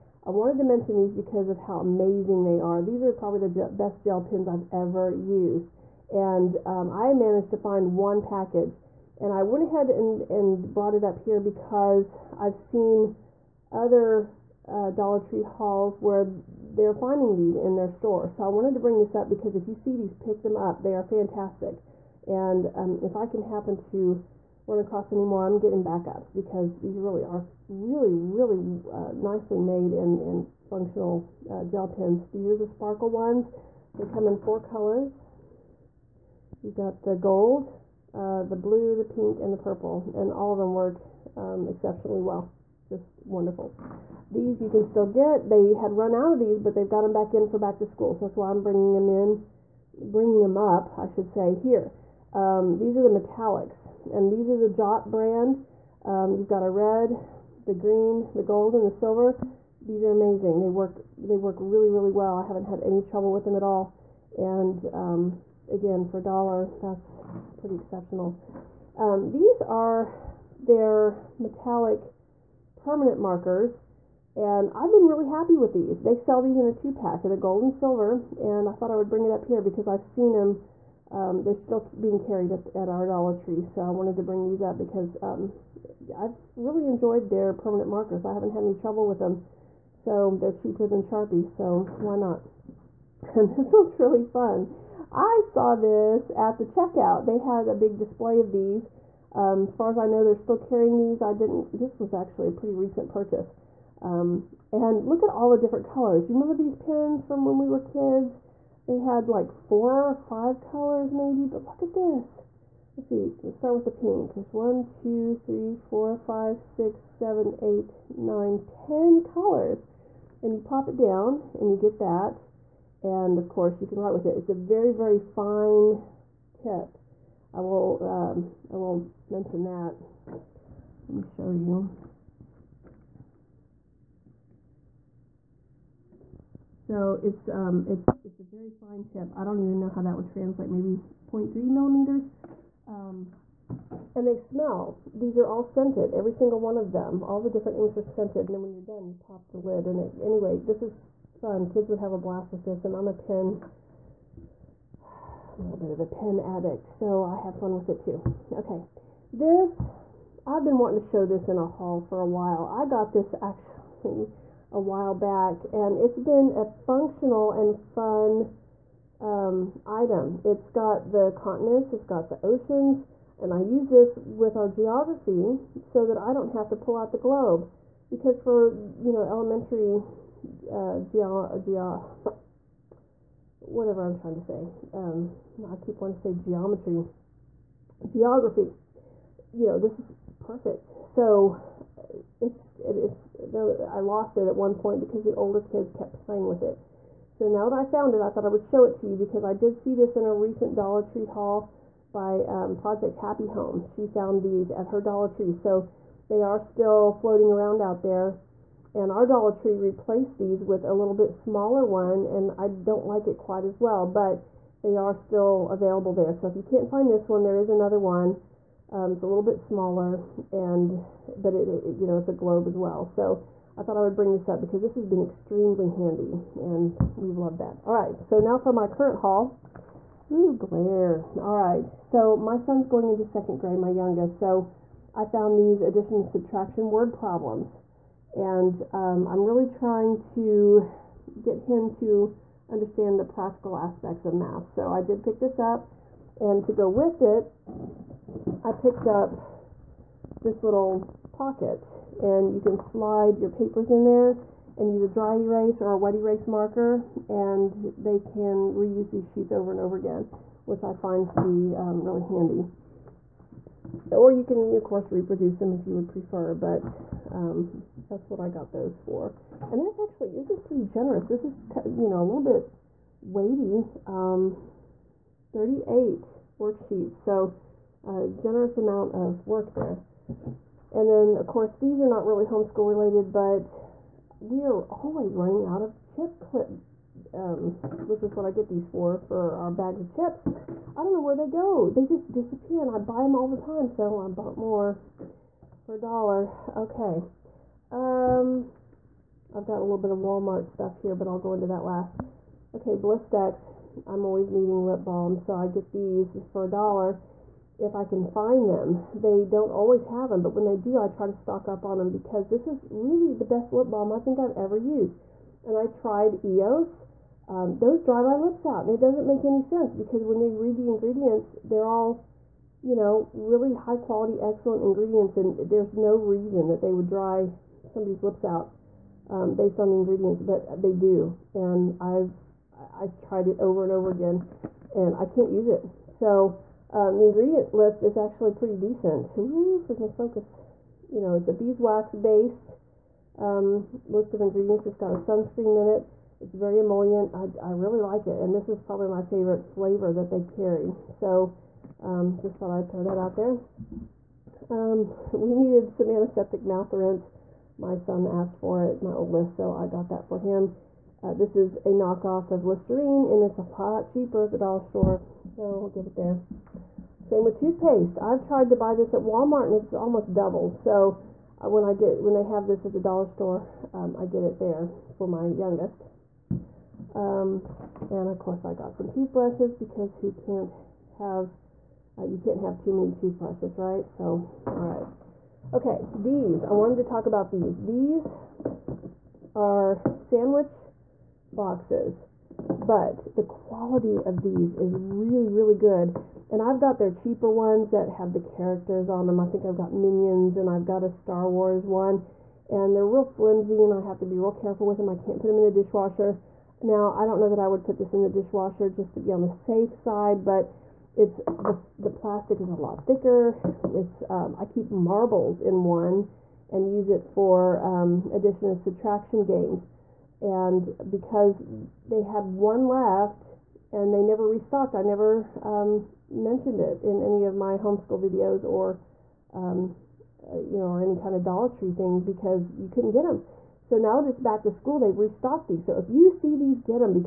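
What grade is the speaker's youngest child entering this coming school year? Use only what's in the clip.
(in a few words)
Second grade.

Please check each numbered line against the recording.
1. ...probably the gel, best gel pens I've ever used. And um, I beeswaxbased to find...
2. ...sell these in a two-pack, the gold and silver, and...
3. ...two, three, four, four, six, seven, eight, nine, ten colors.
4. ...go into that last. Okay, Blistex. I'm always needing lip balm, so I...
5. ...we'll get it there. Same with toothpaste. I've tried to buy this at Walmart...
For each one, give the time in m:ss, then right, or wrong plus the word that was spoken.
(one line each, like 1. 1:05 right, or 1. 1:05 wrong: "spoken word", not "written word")
1. 0:03 wrong: "managed", not "beeswaxbased"
2. 1:16 right
3. 1:54 wrong: "five", not "four"
4. 5:01 right
5. 6:05 right.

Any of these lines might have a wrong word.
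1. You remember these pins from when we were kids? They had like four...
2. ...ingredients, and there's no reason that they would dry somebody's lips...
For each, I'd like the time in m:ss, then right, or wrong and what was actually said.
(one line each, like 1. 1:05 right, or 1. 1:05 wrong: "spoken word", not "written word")
1. 1:46 right
2. 5:24 right.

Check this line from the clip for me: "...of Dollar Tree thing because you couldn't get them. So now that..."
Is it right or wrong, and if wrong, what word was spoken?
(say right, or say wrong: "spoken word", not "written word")
right.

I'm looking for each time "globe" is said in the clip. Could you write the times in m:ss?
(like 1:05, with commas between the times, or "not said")
2:57, 3:42.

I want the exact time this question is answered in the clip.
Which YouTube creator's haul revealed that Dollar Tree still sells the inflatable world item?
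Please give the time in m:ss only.
3:22.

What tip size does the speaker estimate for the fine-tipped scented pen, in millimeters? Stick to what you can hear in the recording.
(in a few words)
0.3 millimeters.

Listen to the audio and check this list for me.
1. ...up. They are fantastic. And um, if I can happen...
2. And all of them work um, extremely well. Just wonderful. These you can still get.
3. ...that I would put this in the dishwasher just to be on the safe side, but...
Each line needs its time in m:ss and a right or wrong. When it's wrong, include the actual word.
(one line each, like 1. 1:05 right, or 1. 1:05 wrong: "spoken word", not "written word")
1. 0:20 right
2. 0:40 wrong: "exceptionally", not "extremely"
3. 6:47 right.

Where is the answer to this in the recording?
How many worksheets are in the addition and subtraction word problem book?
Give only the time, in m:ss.
4:35.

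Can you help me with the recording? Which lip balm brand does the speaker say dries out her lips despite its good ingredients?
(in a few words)
EOS.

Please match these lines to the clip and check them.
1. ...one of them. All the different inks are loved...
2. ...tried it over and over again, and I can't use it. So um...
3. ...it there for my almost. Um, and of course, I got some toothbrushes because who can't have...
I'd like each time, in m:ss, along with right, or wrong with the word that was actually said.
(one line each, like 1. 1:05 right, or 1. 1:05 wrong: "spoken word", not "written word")
1. 2:26 wrong: "scented", not "loved"
2. 5:33 right
3. 6:14 wrong: "youngest", not "almost".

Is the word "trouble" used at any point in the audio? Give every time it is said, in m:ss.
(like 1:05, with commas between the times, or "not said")
1:03, 1:28.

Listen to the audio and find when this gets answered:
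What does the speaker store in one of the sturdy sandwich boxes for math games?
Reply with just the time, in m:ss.
6:54.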